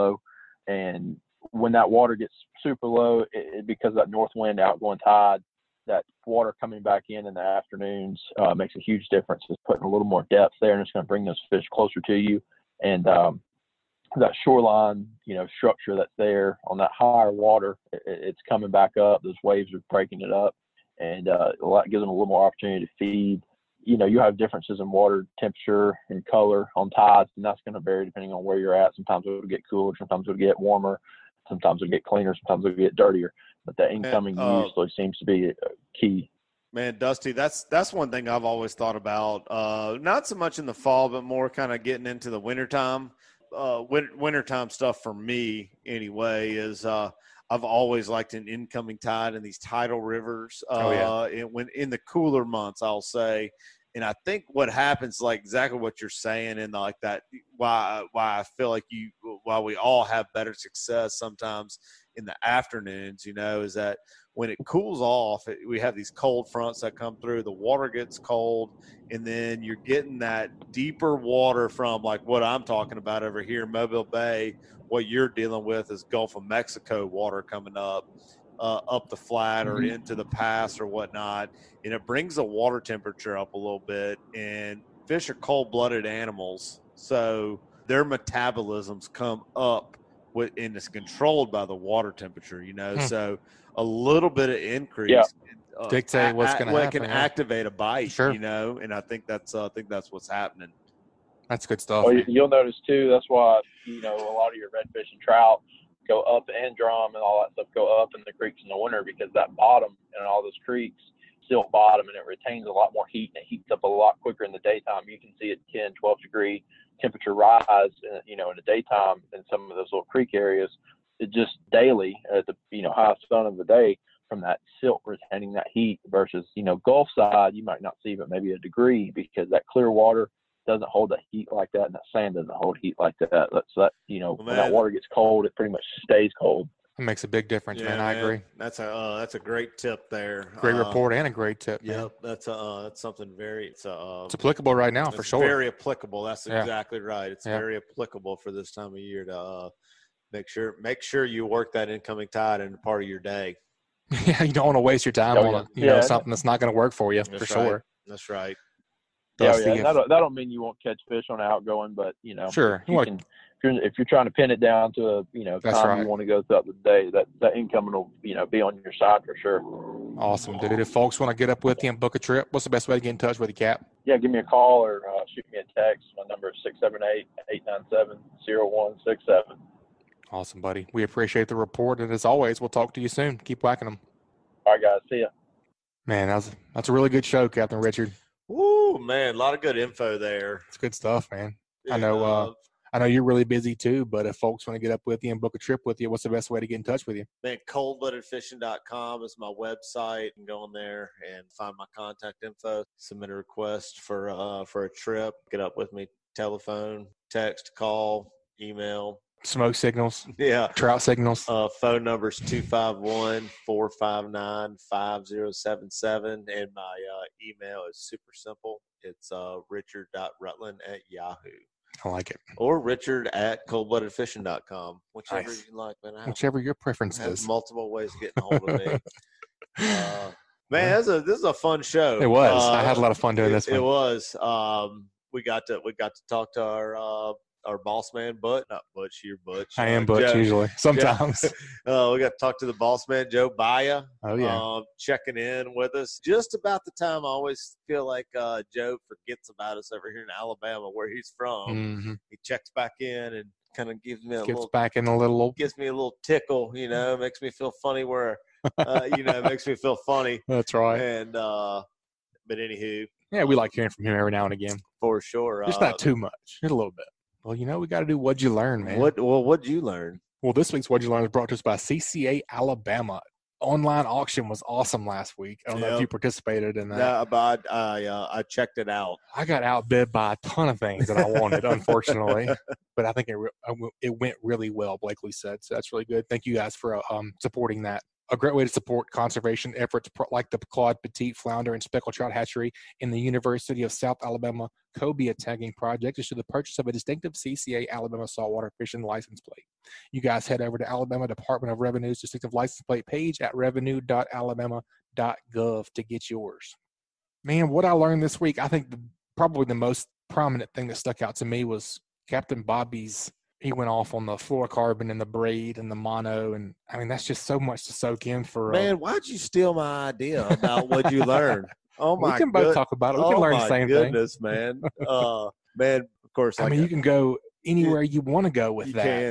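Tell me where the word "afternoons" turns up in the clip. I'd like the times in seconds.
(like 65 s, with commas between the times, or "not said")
7 s, 62 s.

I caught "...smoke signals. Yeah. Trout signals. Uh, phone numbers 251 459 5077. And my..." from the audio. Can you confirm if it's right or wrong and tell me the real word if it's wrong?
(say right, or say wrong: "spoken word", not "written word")
right.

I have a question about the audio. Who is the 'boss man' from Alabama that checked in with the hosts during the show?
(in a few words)
Joe Baya.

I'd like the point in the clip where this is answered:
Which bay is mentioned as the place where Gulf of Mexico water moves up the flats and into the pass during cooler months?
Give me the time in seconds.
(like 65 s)
73 s.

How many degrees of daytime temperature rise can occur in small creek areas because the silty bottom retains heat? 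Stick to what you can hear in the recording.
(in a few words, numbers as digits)
10 to 12 degrees.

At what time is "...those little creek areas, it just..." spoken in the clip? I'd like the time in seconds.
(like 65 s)
119 s.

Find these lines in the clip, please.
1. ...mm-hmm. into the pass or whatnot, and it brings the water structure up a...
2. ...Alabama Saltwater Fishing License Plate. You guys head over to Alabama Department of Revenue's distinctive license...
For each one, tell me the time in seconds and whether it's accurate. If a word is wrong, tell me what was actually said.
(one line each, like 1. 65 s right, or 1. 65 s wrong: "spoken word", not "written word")
1. 79 s wrong: "temperature", not "structure"
2. 297 s right.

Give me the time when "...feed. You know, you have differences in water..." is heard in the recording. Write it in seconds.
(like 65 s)
22 s.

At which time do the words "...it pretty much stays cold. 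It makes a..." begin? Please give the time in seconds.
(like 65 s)
135 s.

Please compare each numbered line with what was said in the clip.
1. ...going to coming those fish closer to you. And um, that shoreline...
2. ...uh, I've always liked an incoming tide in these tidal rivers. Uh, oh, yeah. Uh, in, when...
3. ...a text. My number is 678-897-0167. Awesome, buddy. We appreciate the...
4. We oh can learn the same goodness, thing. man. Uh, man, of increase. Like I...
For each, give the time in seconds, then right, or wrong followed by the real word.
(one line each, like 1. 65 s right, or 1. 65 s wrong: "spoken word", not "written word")
1. 10 s wrong: "bring", not "coming"
2. 46 s right
3. 175 s right
4. 323 s wrong: "course", not "increase".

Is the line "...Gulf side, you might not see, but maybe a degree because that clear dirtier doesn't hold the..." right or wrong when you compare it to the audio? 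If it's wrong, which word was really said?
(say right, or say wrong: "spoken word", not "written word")
wrong: "water", not "dirtier".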